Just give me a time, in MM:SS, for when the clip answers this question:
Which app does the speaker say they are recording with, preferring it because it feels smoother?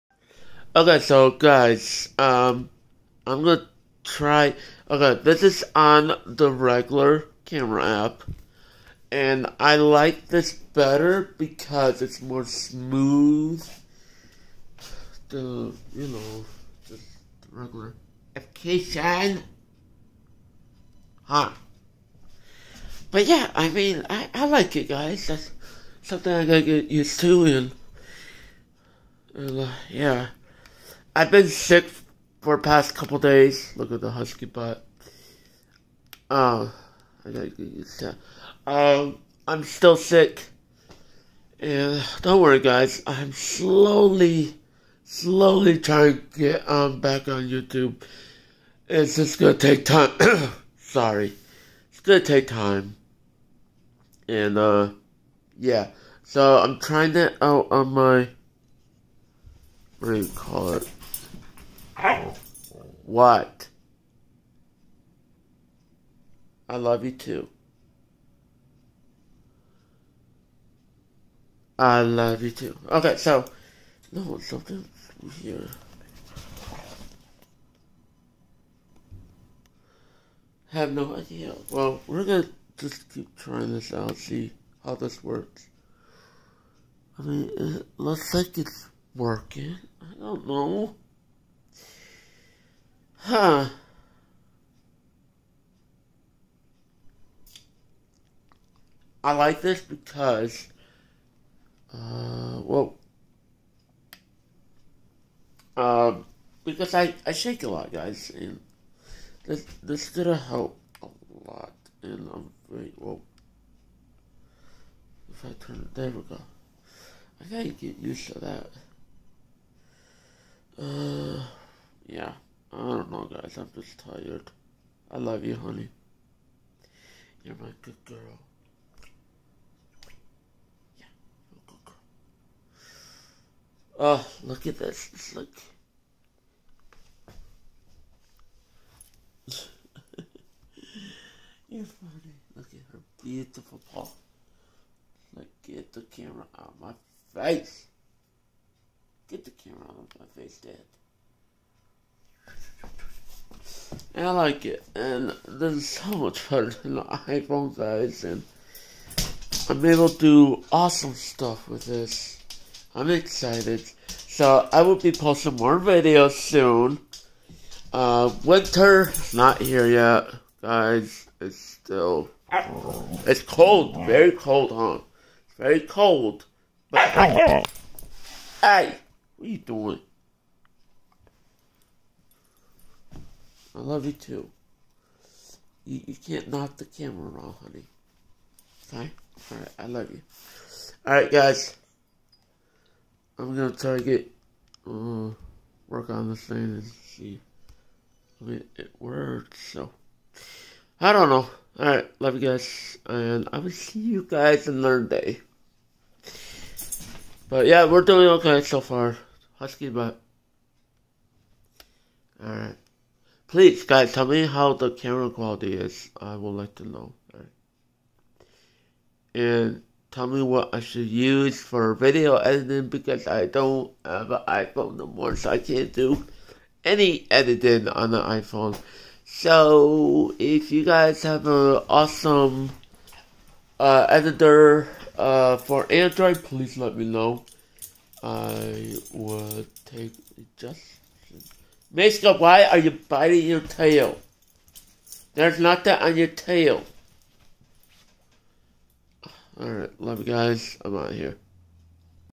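00:06.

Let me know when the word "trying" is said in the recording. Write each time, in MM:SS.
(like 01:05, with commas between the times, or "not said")
00:45, 00:56, 01:23.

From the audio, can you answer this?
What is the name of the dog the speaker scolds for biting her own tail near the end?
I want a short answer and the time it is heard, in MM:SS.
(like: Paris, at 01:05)
Miska, at 04:01.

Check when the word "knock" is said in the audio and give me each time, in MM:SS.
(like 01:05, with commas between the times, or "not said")
03:06.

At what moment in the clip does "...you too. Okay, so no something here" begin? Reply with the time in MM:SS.
01:12.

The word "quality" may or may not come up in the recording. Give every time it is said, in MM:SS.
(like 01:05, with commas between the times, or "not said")
03:35.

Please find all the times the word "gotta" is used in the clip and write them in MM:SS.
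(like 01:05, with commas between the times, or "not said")
00:26, 00:37, 01:57.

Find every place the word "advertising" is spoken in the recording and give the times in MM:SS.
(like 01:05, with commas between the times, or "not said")
not said.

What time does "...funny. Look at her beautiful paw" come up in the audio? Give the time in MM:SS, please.
02:21.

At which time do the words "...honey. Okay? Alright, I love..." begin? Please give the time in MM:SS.
03:07.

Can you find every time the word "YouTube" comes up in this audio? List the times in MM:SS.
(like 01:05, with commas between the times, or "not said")
00:47.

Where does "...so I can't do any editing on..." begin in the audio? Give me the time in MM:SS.
03:45.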